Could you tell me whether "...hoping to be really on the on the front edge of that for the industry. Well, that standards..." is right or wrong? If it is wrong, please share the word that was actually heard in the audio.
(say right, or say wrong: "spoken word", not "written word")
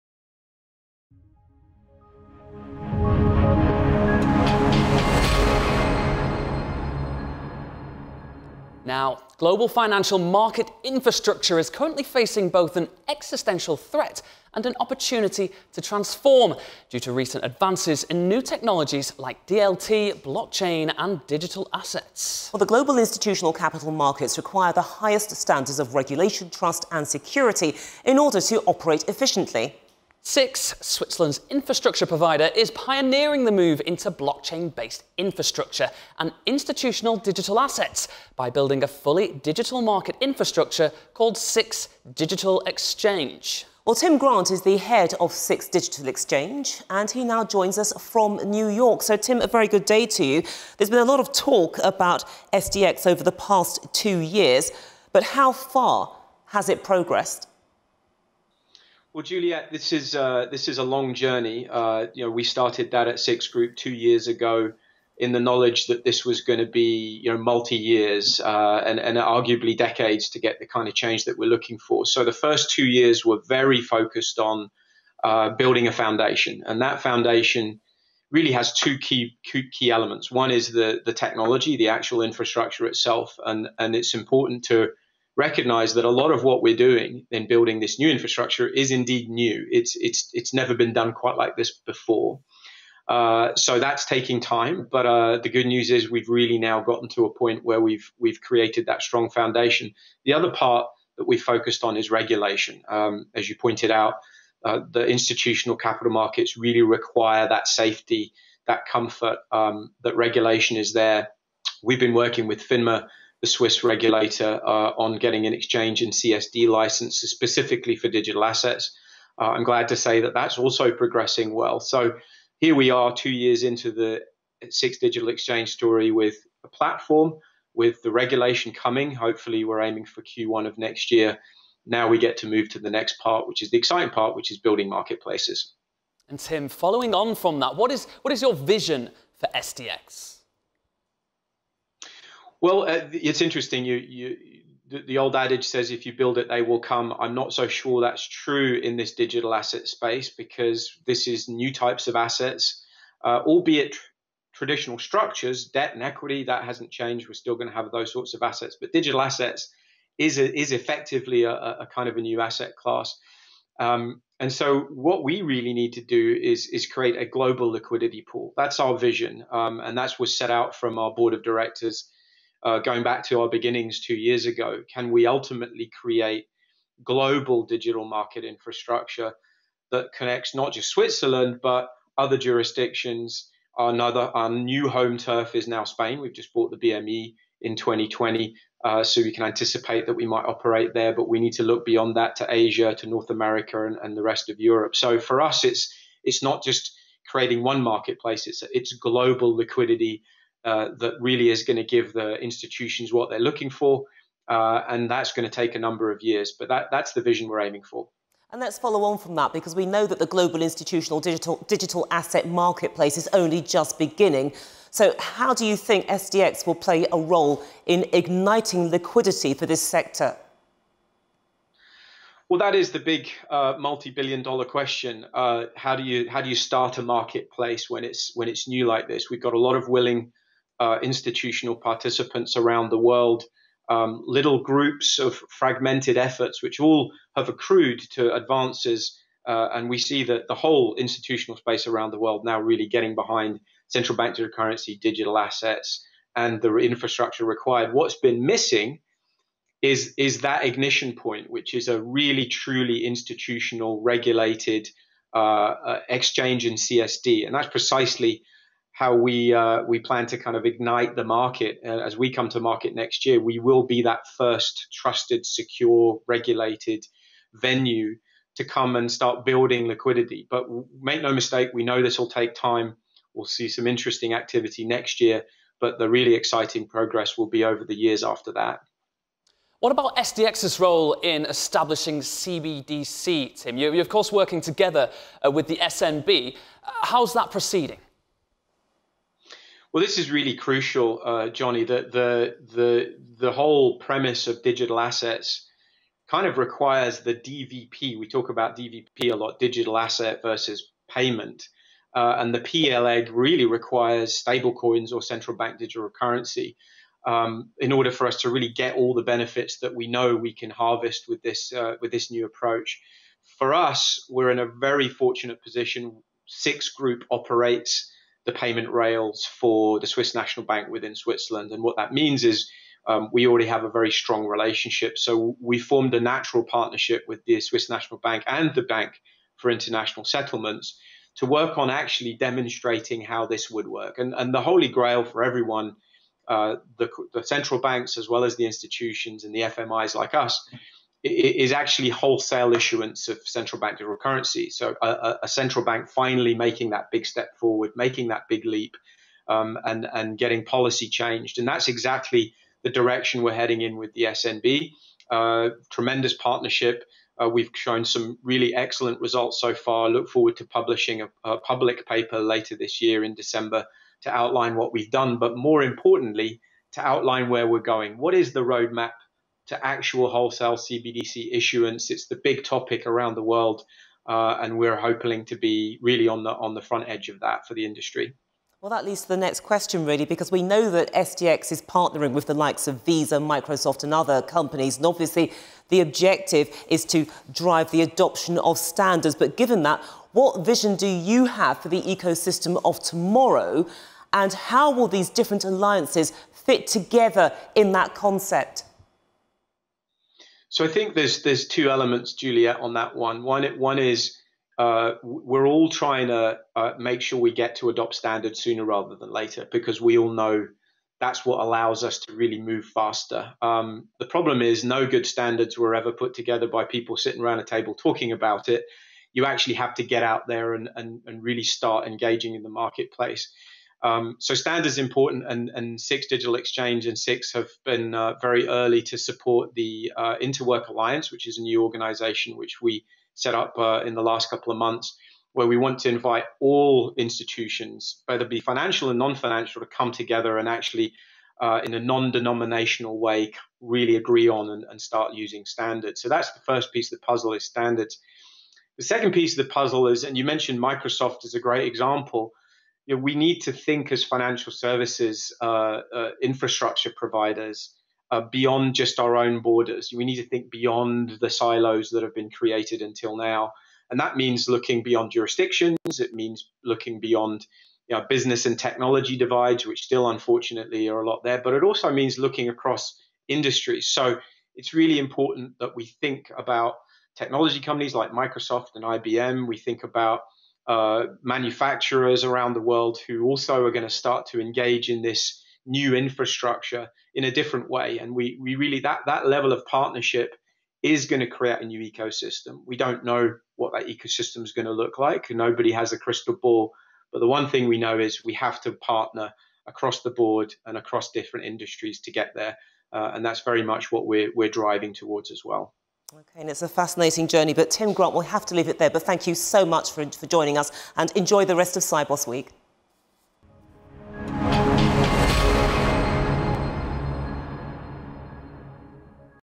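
wrong: "leads", not "standards".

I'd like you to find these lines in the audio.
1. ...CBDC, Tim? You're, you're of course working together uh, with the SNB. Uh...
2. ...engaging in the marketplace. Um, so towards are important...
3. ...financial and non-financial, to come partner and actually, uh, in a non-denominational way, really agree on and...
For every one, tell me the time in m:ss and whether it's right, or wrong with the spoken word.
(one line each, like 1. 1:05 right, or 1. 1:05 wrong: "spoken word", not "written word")
1. 4:42 right
2. 7:02 wrong: "standards", not "towards"
3. 7:18 wrong: "together", not "partner".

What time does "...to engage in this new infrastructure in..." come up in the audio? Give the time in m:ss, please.
8:04.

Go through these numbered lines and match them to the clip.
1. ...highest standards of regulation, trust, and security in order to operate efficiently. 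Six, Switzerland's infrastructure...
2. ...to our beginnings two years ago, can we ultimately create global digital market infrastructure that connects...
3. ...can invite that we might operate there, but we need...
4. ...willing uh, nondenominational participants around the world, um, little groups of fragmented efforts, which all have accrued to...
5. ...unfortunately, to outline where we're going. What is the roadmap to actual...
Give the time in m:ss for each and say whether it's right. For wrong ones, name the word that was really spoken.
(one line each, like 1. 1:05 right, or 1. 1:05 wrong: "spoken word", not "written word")
1. 0:24 right
2. 2:53 right
3. 3:09 wrong: "anticipate", not "invite"
4. 3:49 wrong: "institutional", not "nondenominational"
5. 6:05 wrong: "importantly", not "unfortunately".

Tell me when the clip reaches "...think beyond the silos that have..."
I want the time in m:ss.
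7:40.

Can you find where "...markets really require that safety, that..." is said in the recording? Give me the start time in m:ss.
1:46.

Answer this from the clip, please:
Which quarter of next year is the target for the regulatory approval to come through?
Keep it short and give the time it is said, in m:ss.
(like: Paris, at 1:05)
Q1, at 2:10.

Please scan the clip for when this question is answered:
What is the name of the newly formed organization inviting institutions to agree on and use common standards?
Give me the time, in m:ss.
7:10.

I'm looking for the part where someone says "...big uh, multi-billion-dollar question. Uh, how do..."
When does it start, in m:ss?
3:42.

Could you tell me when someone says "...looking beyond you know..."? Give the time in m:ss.
7:46.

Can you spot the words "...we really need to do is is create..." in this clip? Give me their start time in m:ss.
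2:45.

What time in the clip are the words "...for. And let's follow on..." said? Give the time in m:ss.
3:27.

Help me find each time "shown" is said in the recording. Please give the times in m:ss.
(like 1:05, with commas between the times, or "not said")
5:57.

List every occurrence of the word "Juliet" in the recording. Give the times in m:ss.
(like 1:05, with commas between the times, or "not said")
0:59, 6:42.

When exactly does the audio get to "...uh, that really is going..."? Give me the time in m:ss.
3:20.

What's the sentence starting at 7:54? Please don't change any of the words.
So it's really important that we think about technology companies like Microsoft and IBM.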